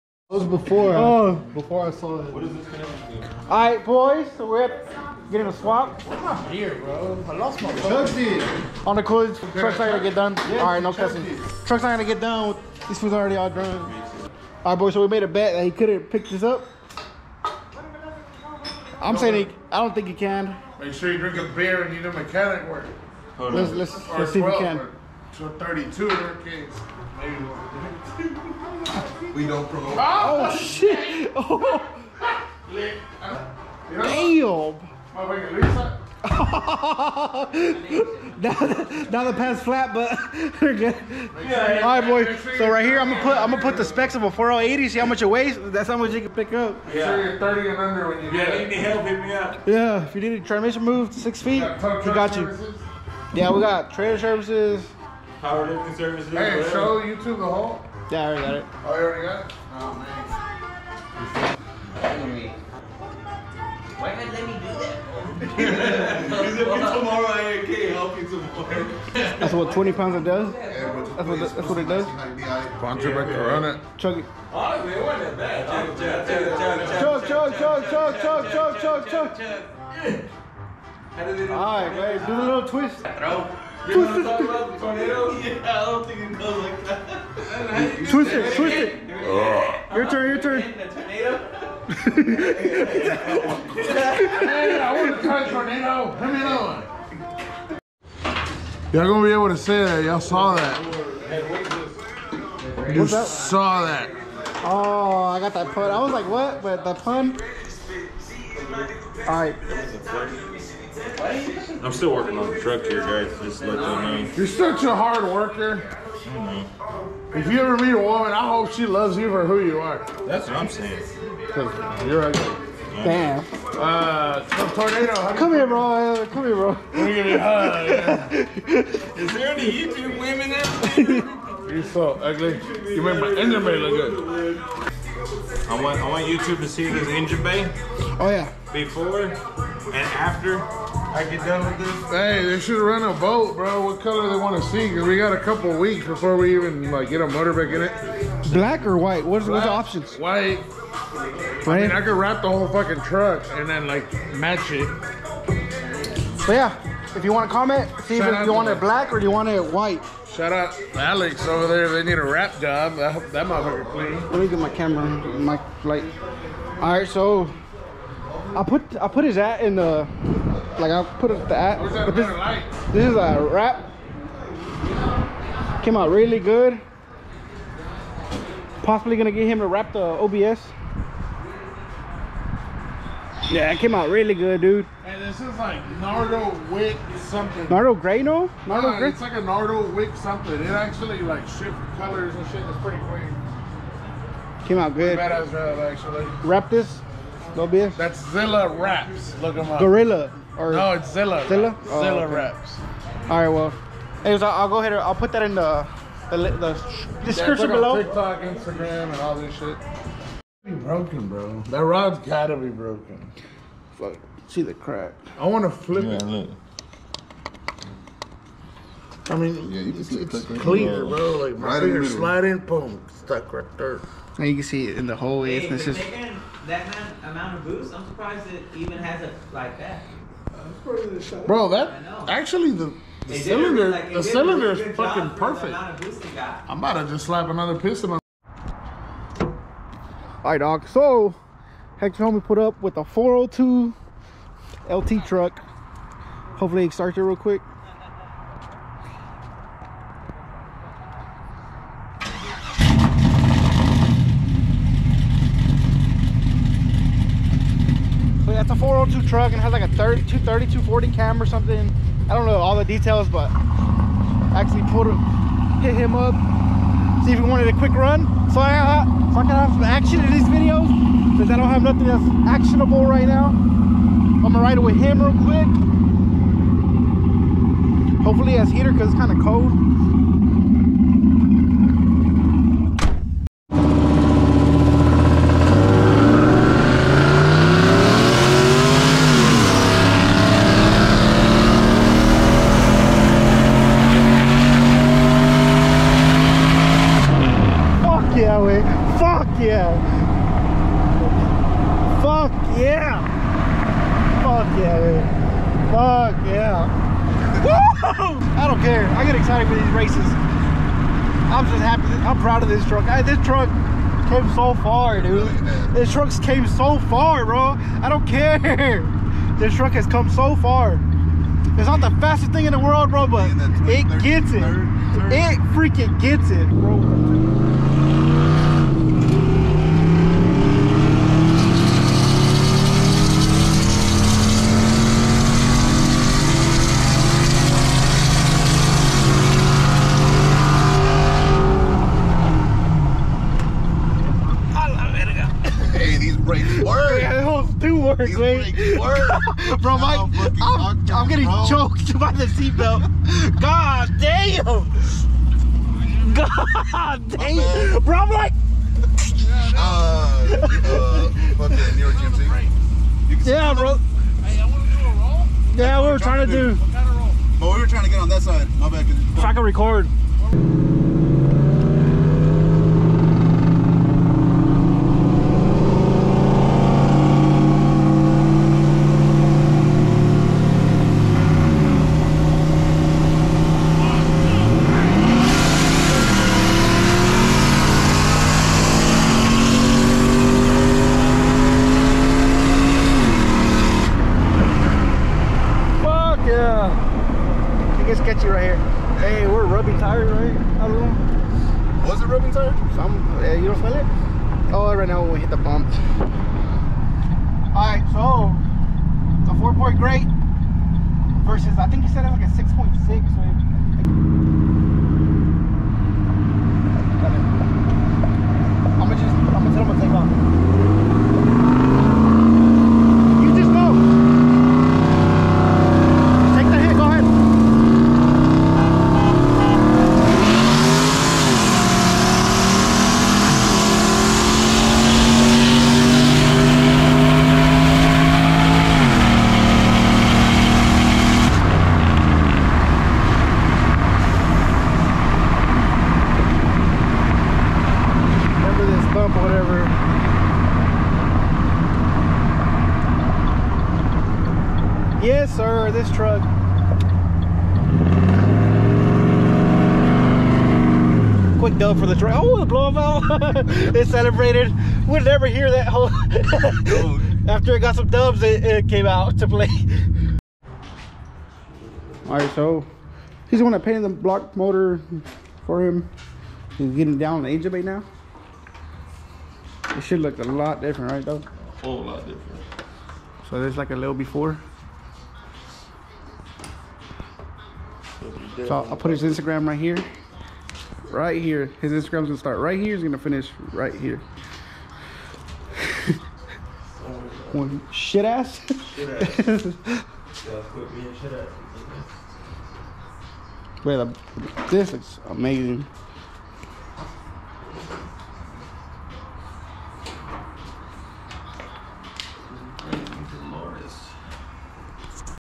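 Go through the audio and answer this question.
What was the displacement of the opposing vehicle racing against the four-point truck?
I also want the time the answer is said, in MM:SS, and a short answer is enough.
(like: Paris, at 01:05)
6.6, at 06:52.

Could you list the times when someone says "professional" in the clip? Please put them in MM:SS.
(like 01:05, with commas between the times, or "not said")
not said.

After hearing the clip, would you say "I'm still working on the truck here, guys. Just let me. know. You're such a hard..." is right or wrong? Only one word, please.
right.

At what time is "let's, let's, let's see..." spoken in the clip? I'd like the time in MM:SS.
00:23.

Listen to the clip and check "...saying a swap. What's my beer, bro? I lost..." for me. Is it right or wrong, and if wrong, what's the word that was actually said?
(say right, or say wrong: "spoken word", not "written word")
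wrong: "getting", not "saying".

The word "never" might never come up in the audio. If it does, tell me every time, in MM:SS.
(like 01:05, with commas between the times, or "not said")
07:45.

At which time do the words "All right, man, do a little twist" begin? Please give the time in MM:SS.
01:21.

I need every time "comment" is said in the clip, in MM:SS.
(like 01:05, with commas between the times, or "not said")
02:37.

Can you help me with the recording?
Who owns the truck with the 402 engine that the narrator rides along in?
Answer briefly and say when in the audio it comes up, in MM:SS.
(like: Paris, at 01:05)
Hector, at 04:01.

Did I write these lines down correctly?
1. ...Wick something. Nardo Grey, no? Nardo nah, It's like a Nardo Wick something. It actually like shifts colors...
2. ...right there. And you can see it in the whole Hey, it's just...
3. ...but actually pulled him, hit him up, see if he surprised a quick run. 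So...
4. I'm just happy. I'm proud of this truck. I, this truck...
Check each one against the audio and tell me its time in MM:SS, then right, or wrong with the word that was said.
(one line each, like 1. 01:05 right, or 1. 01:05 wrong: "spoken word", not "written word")
1. 03:06 right
2. 03:43 right
3. 04:23 wrong: "wanted", not "surprised"
4. 05:11 right.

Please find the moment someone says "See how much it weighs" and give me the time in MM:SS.
00:44.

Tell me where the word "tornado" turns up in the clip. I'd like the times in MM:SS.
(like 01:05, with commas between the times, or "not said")
01:24, 01:35, 02:04.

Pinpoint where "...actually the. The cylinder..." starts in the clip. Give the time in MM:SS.
03:52.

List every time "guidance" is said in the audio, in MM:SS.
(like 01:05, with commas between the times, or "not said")
not said.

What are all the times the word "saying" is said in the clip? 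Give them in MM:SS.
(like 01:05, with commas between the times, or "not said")
00:19, 02:00.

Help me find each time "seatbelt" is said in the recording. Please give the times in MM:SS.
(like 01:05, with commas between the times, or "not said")
05:52.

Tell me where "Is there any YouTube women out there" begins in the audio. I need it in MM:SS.
02:09.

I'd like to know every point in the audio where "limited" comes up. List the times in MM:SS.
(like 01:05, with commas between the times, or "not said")
not said.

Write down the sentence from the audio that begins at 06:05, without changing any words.
Yeah, we were trying, trying to do.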